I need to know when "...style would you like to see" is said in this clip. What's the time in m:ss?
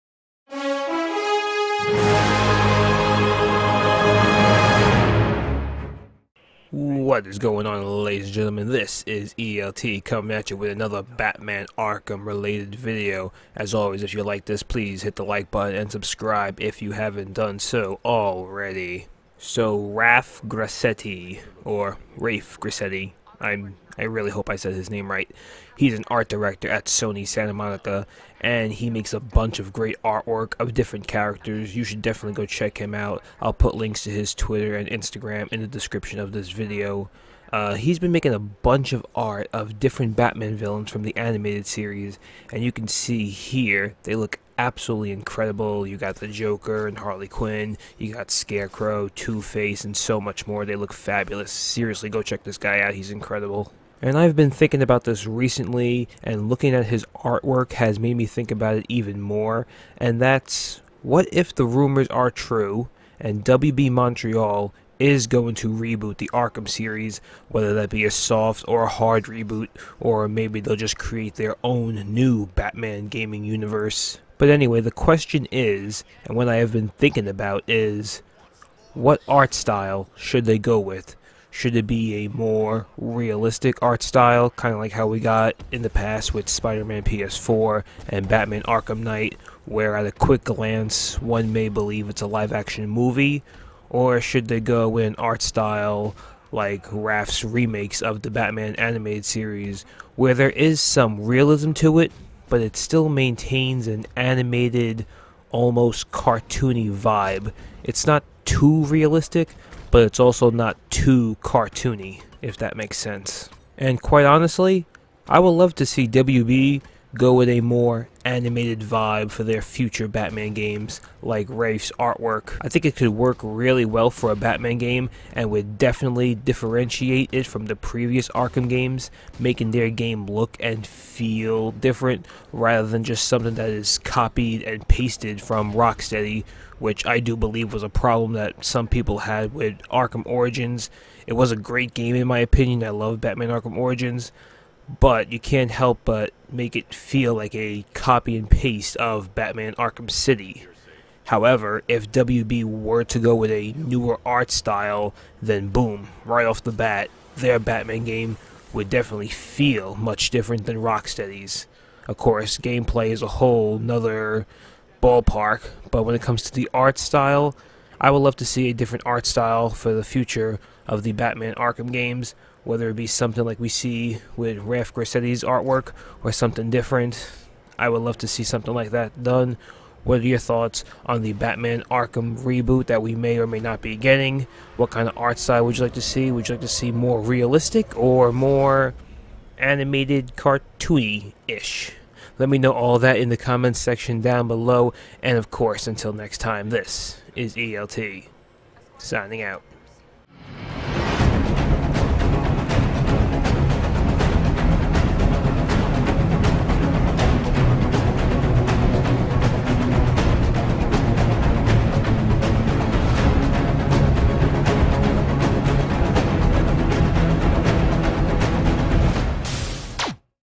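3:05.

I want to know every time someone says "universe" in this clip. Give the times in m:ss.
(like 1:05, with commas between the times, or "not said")
1:13.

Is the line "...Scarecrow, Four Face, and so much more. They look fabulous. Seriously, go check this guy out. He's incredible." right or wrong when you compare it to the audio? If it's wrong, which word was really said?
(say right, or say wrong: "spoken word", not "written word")
wrong: "Two", not "Four".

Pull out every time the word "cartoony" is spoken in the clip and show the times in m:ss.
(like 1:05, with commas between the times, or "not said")
1:46, 1:51, 3:10.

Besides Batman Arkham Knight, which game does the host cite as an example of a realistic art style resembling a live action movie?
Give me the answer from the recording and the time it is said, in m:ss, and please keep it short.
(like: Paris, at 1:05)
Spider Man PS4, at 1:26.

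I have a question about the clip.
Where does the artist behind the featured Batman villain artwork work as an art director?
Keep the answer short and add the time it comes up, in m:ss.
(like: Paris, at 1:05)
Sony Santa Monica, at 0:26.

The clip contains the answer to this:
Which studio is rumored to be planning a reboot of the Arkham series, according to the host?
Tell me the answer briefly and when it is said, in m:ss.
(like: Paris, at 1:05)
WB Montreal, at 1:03.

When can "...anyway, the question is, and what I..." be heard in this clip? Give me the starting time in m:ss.
1:14.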